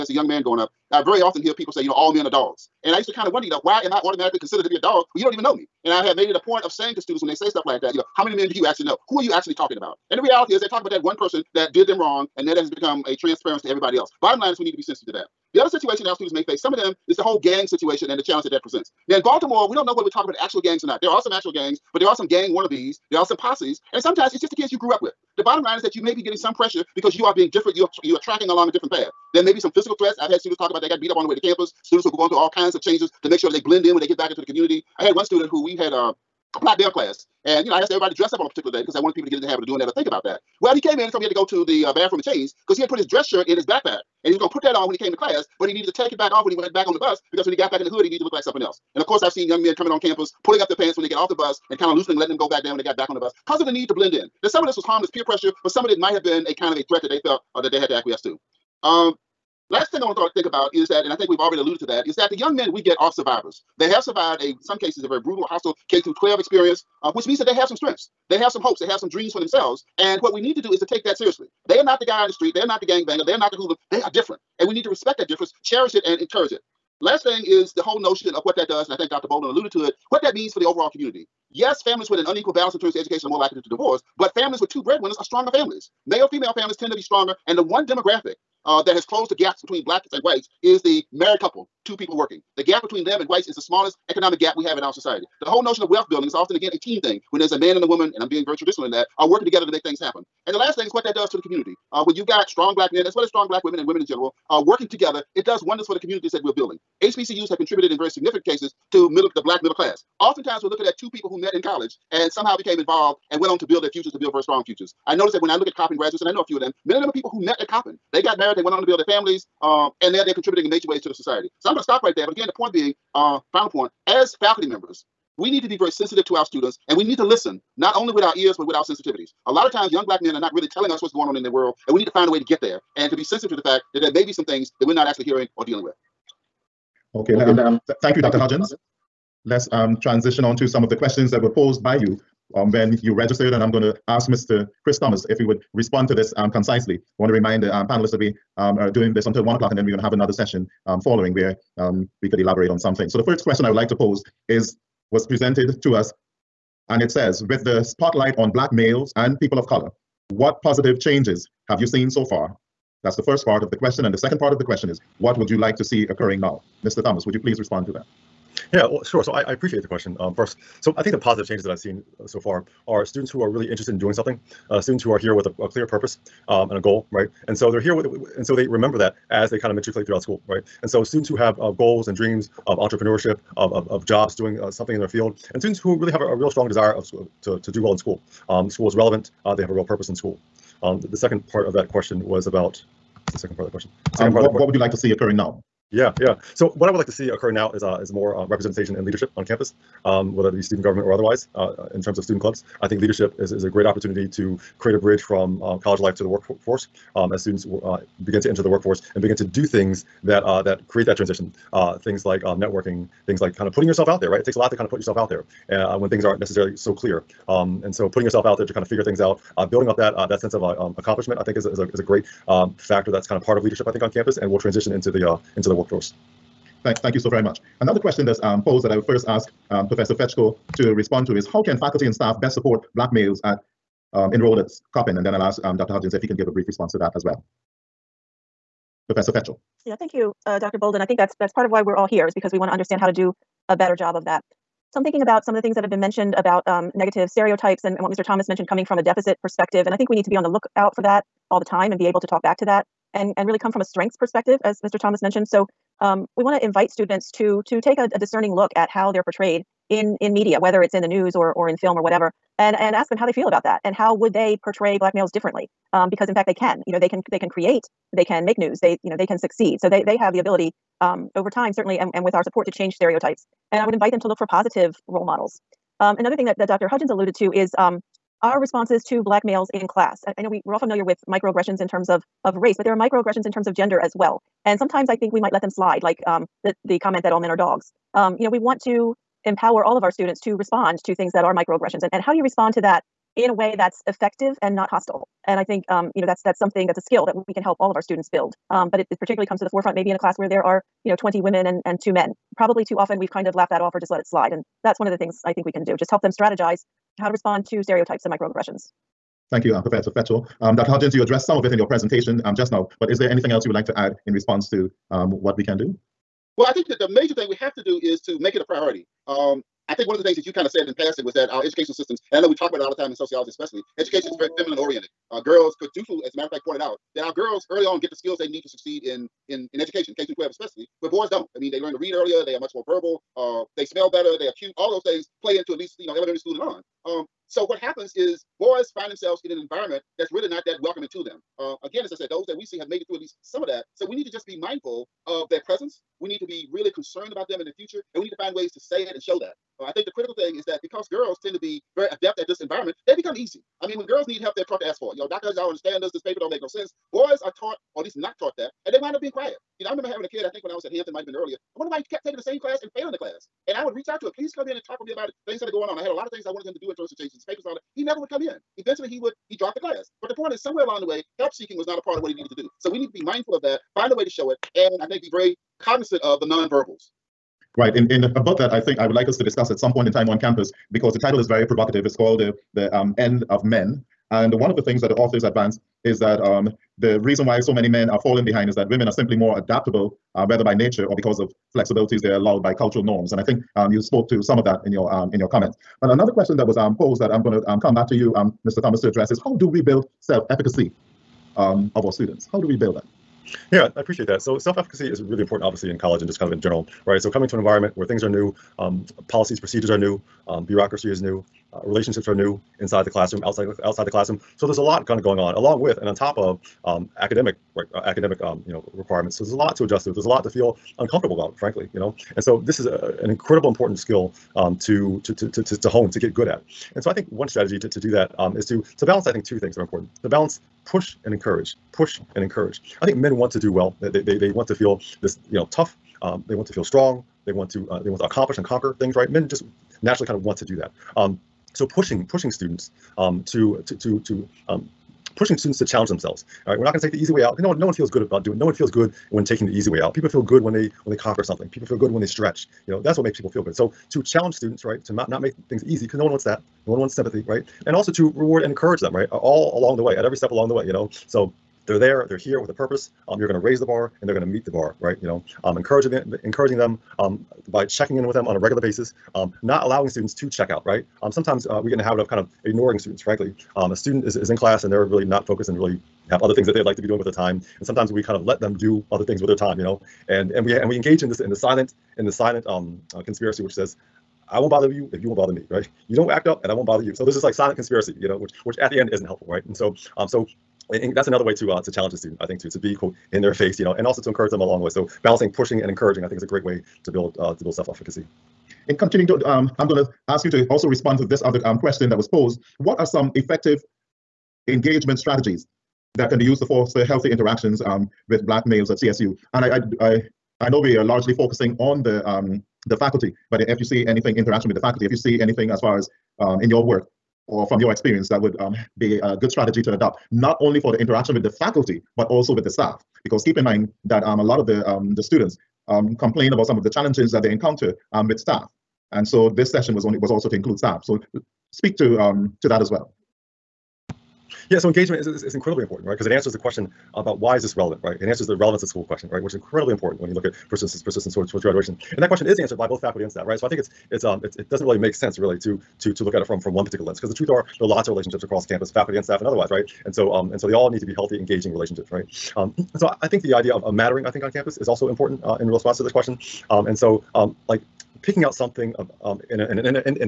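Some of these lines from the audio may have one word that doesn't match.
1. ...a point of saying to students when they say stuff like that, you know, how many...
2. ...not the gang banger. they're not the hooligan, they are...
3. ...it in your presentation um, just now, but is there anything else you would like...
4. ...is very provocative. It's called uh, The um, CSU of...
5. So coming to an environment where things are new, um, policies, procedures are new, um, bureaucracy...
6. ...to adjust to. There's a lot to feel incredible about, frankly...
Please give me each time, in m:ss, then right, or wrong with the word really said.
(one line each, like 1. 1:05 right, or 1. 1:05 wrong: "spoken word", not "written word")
1. 0:06 right
2. 1:12 right
3. 5:11 right
4. 6:21 wrong: "End", not "CSU"
5. 6:47 right
6. 6:59 wrong: "uncomfortable", not "incredible".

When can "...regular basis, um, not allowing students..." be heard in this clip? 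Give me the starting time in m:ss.
7:48.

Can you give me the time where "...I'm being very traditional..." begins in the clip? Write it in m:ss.
1:38.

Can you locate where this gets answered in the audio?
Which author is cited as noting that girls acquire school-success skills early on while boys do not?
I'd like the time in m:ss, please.
5:25.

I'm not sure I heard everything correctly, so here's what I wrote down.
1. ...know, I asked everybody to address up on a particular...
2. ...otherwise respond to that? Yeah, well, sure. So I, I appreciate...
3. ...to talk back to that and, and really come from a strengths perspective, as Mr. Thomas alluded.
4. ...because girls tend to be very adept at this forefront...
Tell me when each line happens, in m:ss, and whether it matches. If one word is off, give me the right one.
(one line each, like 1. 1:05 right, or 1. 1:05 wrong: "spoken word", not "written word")
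1. 0:37 wrong: "dress", not "address"
2. 2:47 wrong: "please", not "otherwise"
3. 4:12 wrong: "mentioned", not "alluded"
4. 5:50 wrong: "environment", not "forefront".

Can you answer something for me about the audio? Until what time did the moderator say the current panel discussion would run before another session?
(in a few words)
one o'clock.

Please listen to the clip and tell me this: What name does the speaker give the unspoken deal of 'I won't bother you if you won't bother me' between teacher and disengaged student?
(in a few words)
silent conspiracy.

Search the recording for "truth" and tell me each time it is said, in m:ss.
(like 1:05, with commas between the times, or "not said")
9:07.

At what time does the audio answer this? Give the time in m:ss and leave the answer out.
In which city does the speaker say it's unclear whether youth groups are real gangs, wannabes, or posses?
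0:19.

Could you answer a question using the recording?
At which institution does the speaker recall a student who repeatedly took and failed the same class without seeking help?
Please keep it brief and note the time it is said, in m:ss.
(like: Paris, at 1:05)
Hampton, at 6:00.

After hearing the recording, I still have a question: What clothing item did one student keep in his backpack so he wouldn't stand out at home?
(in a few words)
dress shirt.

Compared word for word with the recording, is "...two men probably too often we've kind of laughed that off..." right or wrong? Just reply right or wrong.
right.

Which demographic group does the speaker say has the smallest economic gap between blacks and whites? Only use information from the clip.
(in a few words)
the married couple.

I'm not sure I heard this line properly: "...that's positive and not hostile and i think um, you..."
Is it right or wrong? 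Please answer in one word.
wrong.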